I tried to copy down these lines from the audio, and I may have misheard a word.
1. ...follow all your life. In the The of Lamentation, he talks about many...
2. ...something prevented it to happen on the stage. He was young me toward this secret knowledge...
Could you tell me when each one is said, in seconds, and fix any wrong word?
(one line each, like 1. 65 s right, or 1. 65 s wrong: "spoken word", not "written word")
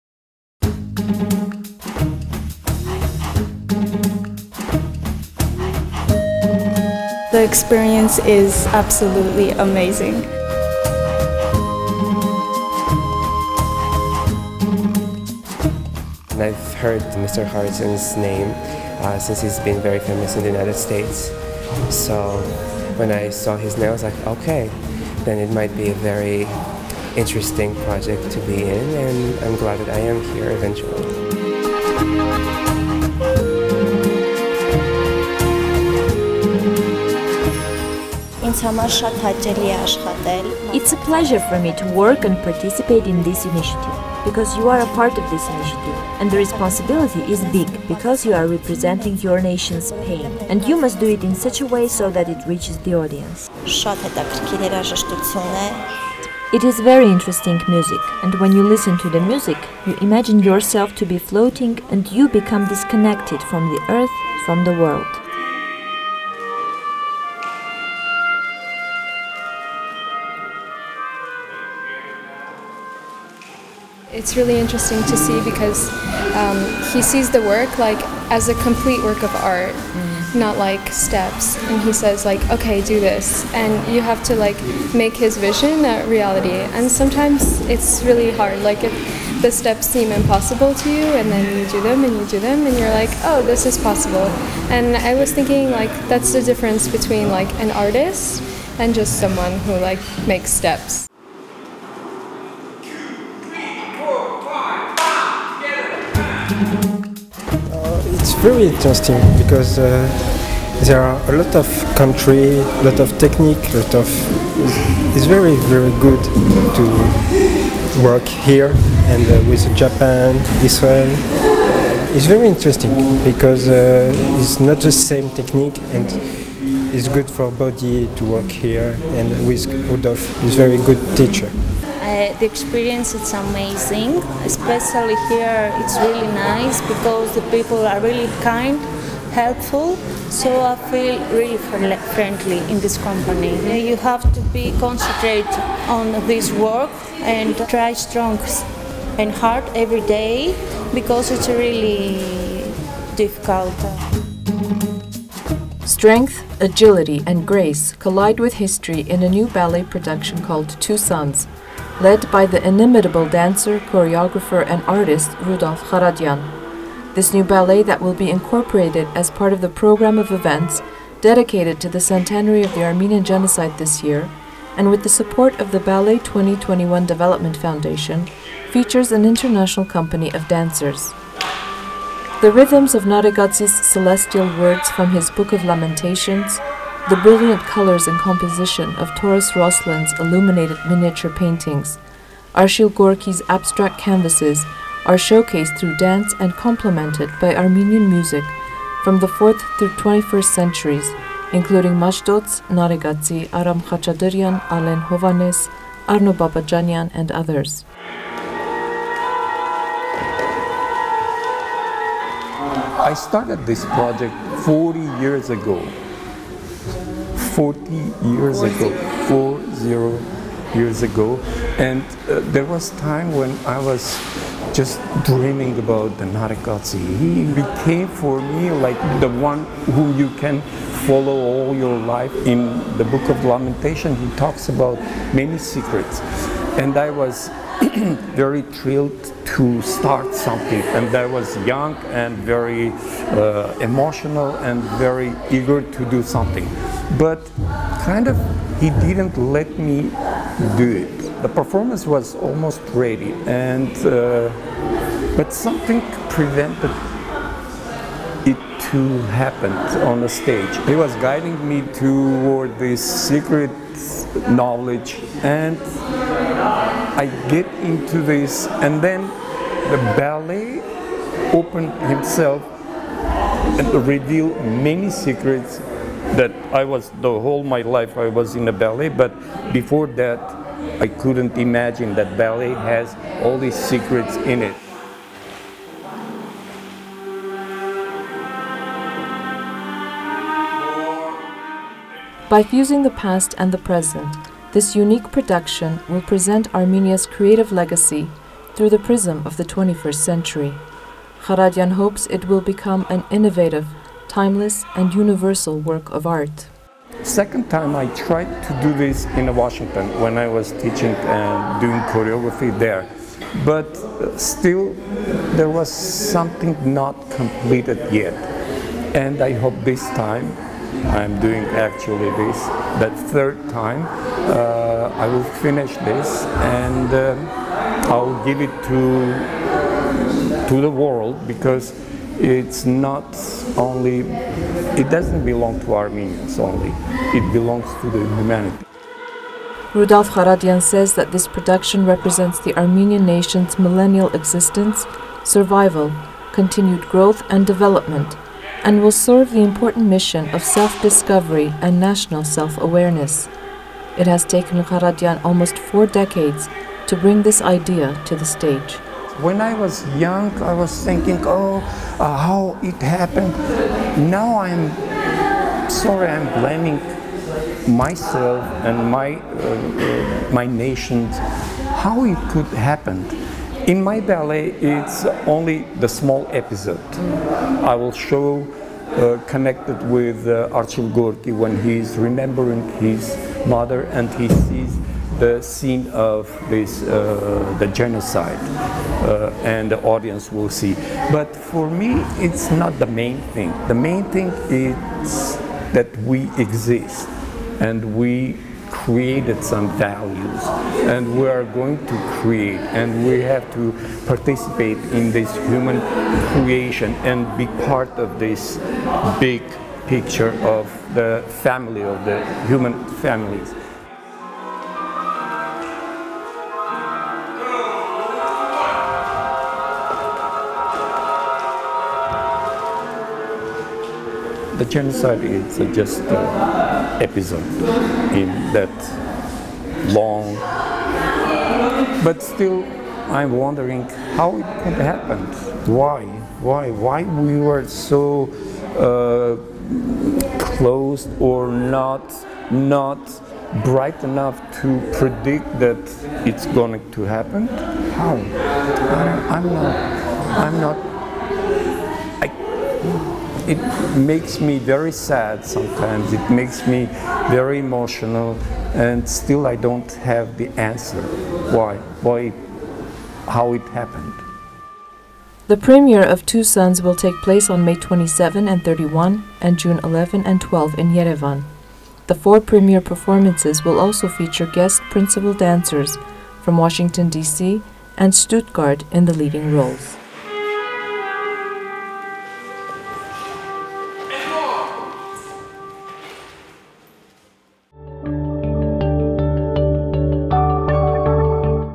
1. 231 s wrong: "Book", not "The"
2. 255 s wrong: "guiding", not "young".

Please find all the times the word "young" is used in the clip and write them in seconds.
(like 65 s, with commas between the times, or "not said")
241 s, 360 s.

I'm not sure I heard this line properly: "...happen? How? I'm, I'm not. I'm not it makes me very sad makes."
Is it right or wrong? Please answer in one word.
wrong.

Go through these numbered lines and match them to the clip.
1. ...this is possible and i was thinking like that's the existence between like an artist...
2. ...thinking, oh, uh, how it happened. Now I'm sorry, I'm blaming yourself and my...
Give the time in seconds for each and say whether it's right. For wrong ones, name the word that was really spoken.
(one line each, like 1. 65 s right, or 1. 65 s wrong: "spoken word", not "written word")
1. 93 s wrong: "difference", not "existence"
2. 361 s wrong: "myself", not "yourself".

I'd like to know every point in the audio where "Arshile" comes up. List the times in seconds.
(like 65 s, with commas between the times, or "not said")
192 s, 380 s.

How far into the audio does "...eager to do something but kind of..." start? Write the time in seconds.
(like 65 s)
245 s.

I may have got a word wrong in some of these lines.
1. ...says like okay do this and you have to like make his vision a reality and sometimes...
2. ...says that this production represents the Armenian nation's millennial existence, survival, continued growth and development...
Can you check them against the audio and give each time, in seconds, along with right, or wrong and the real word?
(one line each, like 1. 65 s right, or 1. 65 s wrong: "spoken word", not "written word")
1. 81 s right
2. 340 s right.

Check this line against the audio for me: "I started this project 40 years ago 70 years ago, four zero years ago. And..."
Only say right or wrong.
wrong.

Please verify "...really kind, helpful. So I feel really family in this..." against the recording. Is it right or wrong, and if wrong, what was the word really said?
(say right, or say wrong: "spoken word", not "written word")
wrong: "friendly", not "family".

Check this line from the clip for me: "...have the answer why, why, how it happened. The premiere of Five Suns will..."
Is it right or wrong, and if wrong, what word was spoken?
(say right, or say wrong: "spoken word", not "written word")
wrong: "Two", not "Five".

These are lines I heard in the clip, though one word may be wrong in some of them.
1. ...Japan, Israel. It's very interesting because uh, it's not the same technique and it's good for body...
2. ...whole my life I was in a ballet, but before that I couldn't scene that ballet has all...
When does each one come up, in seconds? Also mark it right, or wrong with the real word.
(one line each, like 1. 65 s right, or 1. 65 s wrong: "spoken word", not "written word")
1. 119 s right
2. 277 s wrong: "imagine", not "scene".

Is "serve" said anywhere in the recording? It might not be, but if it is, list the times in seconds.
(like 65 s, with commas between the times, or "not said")
349 s.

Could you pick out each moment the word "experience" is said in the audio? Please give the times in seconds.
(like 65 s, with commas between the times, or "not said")
7 s, 132 s.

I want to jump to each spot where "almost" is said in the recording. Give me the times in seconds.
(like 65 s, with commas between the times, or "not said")
252 s, 355 s.